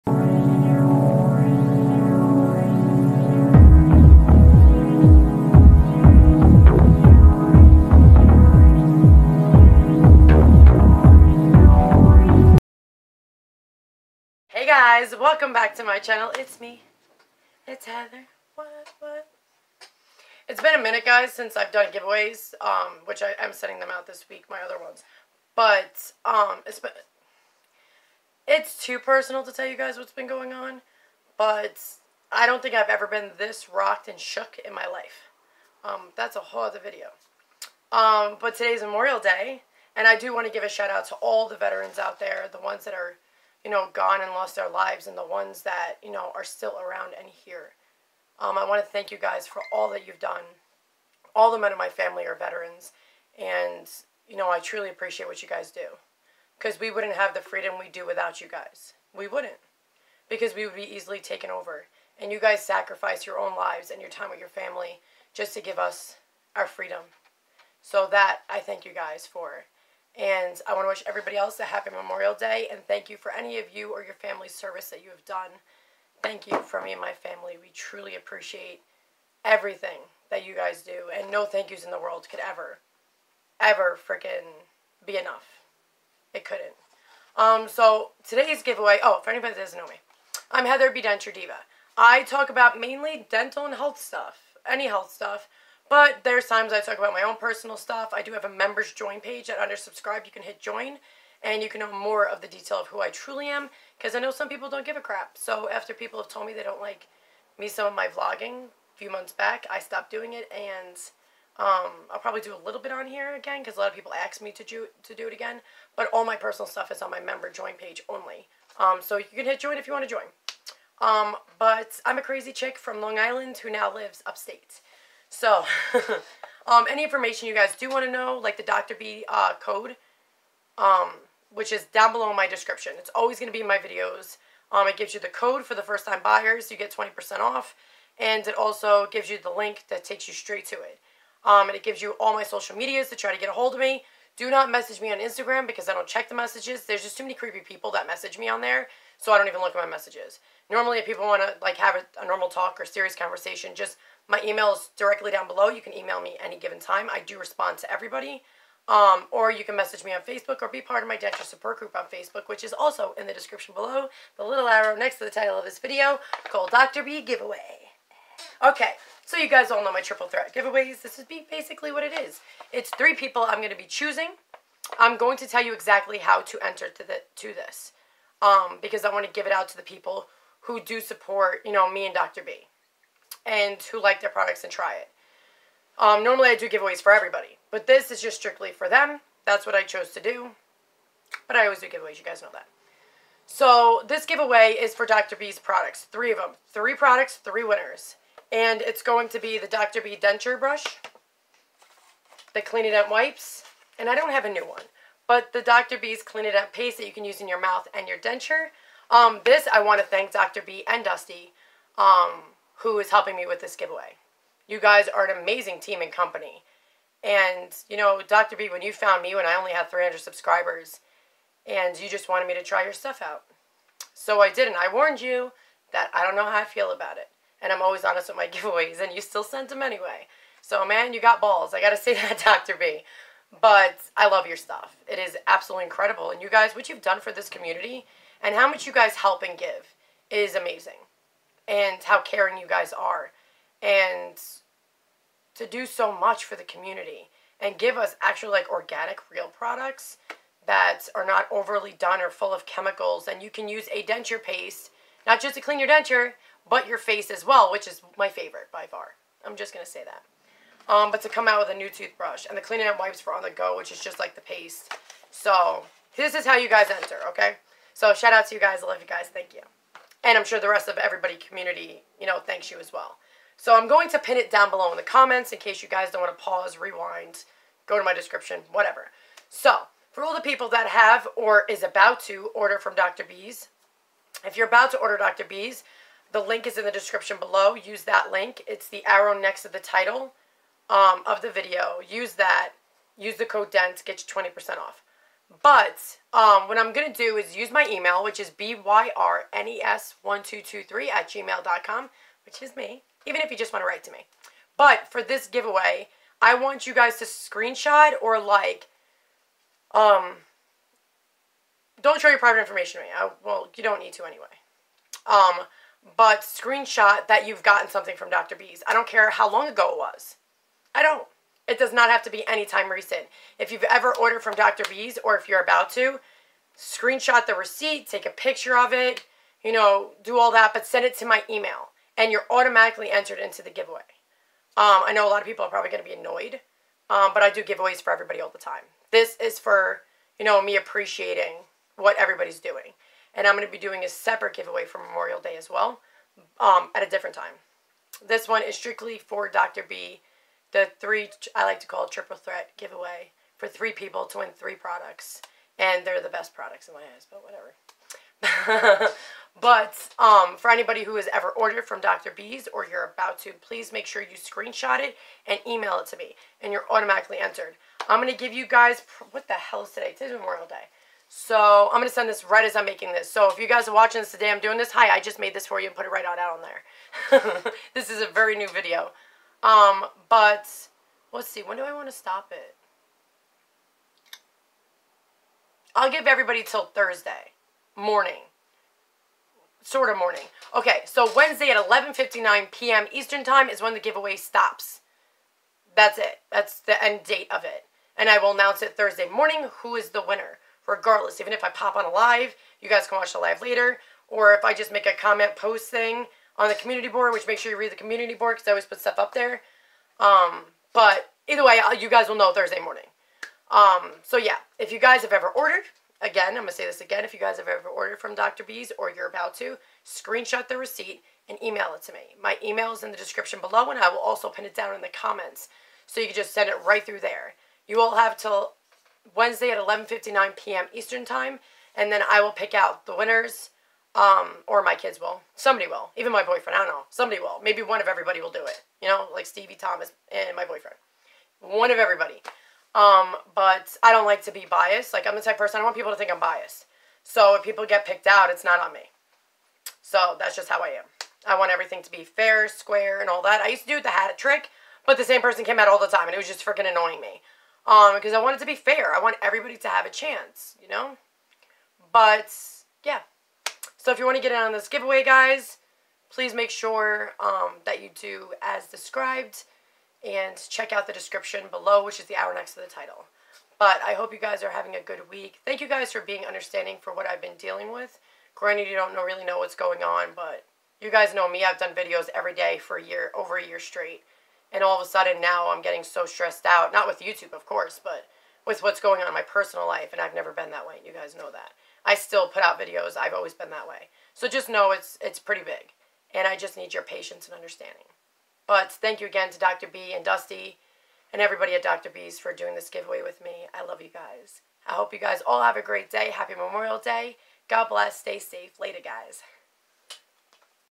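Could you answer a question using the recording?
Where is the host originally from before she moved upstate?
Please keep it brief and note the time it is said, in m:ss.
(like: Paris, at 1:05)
Long Island, at 2:03.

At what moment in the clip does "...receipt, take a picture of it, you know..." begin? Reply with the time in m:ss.
5:27.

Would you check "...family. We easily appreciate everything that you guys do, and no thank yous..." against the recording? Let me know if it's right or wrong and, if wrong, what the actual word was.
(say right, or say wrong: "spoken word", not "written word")
wrong: "truly", not "easily".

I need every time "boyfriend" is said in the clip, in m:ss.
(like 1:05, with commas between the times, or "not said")
7:16, 7:20.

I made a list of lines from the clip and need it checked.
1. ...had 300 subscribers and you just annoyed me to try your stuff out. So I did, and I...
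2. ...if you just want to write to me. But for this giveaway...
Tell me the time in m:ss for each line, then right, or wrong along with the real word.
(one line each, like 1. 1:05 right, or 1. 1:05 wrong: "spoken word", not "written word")
1. 3:39 wrong: "wanted", not "annoyed"
2. 5:03 right.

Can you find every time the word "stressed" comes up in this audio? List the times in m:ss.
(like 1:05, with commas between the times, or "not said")
8:06.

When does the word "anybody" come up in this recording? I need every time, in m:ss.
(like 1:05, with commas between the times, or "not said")
1:29, 6:00.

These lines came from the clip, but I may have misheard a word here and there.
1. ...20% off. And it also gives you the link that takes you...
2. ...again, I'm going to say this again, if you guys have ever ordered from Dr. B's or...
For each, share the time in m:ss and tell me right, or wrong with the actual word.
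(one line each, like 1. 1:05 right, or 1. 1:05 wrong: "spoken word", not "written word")
1. 2:16 right
2. 6:56 right.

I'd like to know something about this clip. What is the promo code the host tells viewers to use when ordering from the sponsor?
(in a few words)
DENT.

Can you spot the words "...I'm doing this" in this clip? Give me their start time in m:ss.
6:14.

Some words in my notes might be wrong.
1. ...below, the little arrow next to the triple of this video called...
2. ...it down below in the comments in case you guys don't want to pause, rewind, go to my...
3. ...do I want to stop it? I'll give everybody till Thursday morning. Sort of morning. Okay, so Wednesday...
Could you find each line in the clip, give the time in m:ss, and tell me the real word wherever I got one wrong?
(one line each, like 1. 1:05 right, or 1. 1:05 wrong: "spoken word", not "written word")
1. 2:43 wrong: "title", not "triple"
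2. 4:34 right
3. 6:21 right.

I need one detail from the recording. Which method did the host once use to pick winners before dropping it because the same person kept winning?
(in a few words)
the hat trick.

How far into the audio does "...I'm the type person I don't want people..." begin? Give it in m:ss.
7:25.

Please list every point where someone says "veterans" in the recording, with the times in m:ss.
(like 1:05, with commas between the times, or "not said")
0:41, 0:52.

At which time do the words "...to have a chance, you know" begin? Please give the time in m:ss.
7:39.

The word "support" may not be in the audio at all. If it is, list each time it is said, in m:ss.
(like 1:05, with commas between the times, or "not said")
2:41, 3:01.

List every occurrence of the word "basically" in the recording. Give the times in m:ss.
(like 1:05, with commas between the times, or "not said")
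2:51.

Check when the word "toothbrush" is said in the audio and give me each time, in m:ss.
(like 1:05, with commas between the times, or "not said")
4:21.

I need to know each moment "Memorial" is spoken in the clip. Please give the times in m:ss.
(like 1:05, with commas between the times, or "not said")
0:38, 1:11, 5:44, 6:10, 8:26.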